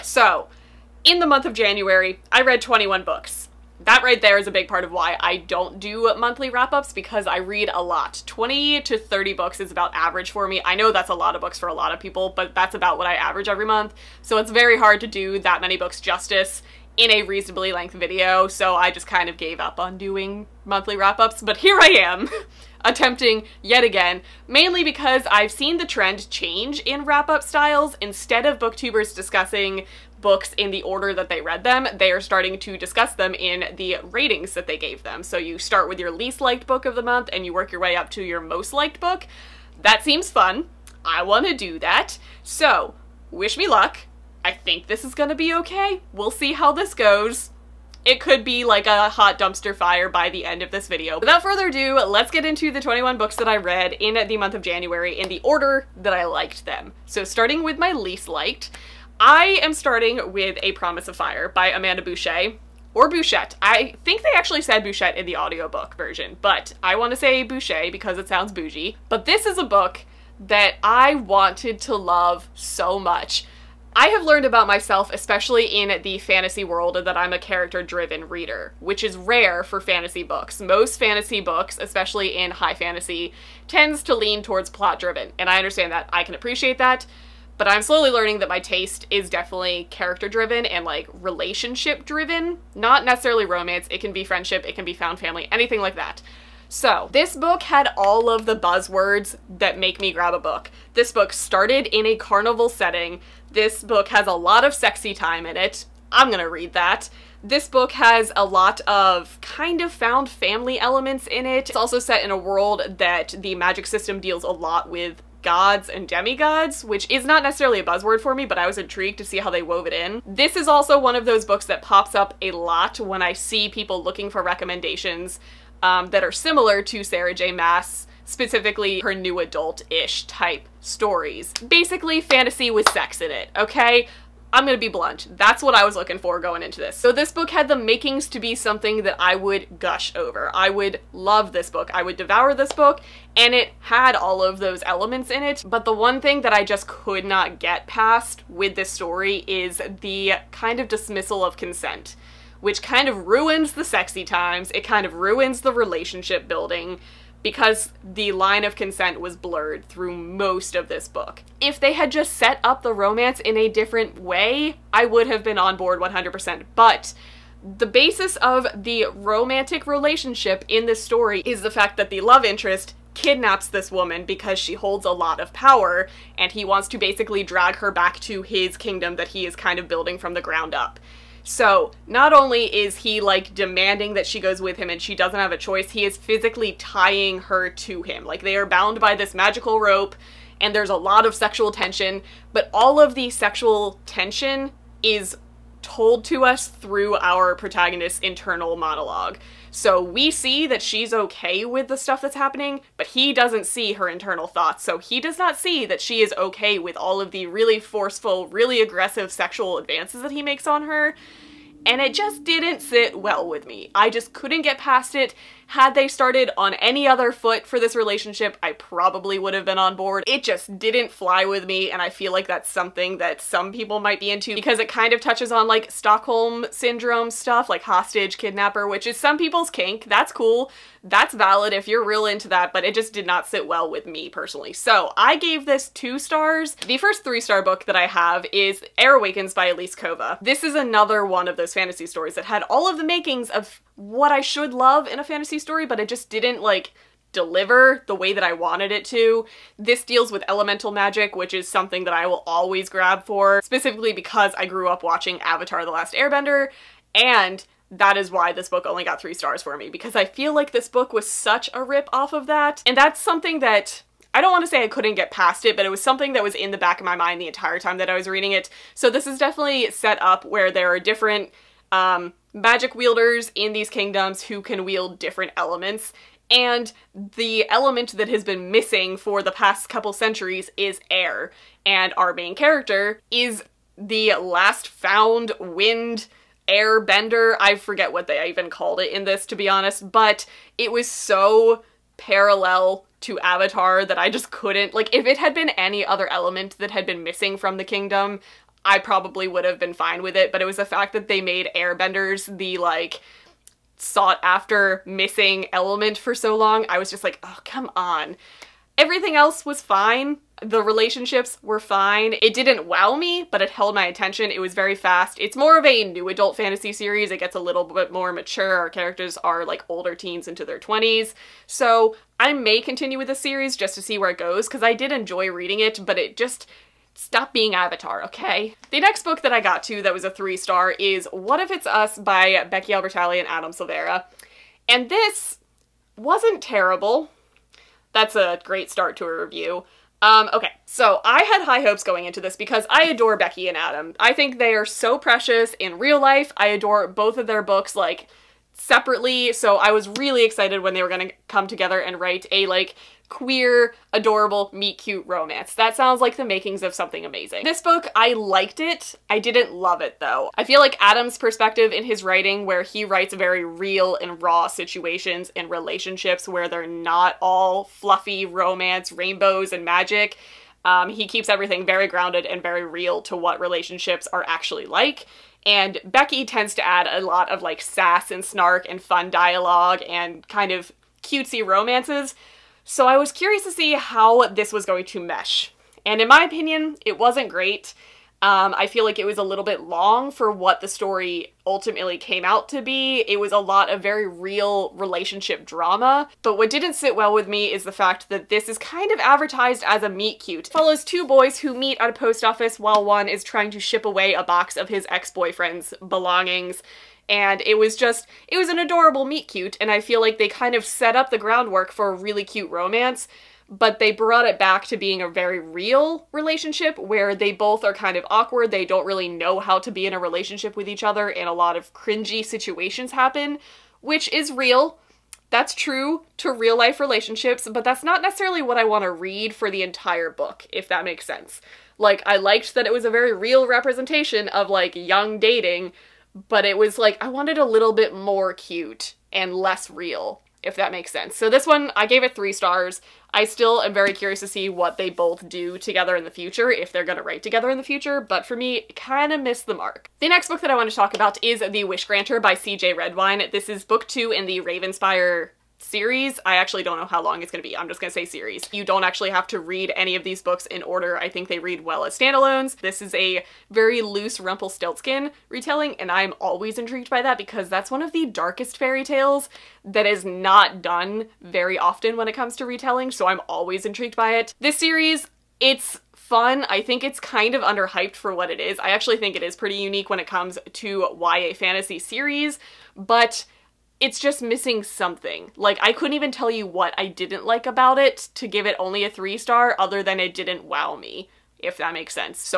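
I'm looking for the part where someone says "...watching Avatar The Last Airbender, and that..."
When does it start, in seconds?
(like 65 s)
255 s.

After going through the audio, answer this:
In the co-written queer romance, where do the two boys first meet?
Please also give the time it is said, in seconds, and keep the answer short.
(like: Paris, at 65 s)
A post office, at 402 s.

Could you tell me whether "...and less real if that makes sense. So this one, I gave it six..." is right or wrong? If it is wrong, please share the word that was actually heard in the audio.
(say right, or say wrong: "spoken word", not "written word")
wrong: "three", not "six".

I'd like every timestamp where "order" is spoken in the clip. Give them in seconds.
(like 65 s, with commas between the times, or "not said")
30 s, 55 s, 460 s.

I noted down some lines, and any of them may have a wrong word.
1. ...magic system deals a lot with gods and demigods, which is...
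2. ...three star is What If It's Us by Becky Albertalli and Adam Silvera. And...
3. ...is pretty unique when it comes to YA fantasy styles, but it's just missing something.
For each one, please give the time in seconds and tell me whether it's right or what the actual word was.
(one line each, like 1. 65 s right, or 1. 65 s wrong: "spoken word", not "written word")
1. 113 s right
2. 330 s right
3. 479 s wrong: "series", not "styles".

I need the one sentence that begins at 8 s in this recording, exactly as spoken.
20 to 30 books is about average for me.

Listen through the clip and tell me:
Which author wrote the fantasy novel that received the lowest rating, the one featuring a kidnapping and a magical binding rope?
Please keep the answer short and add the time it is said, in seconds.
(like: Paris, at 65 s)
Amanda Boucher, at 61 s.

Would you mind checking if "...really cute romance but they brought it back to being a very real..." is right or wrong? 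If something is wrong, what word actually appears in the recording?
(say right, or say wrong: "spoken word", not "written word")
right.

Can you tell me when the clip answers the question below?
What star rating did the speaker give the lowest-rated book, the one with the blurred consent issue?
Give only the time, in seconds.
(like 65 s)
235 s.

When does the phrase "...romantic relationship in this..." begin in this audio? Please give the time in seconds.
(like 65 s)
169 s.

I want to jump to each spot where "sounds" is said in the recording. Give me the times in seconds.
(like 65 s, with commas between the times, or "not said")
68 s, 355 s.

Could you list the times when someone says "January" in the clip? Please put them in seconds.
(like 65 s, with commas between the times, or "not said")
1 s, 54 s.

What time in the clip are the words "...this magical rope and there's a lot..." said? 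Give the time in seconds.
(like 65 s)
189 s.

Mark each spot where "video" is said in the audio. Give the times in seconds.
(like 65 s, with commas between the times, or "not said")
17 s, 50 s.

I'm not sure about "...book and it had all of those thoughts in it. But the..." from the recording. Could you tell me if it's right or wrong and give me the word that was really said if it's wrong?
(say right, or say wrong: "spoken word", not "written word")
wrong: "elements", not "thoughts".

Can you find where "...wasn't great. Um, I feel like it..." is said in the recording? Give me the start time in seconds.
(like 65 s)
387 s.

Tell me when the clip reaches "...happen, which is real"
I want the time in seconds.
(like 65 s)
423 s.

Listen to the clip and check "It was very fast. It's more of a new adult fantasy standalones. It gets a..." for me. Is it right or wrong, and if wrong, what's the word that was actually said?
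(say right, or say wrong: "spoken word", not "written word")
wrong: "series", not "standalones".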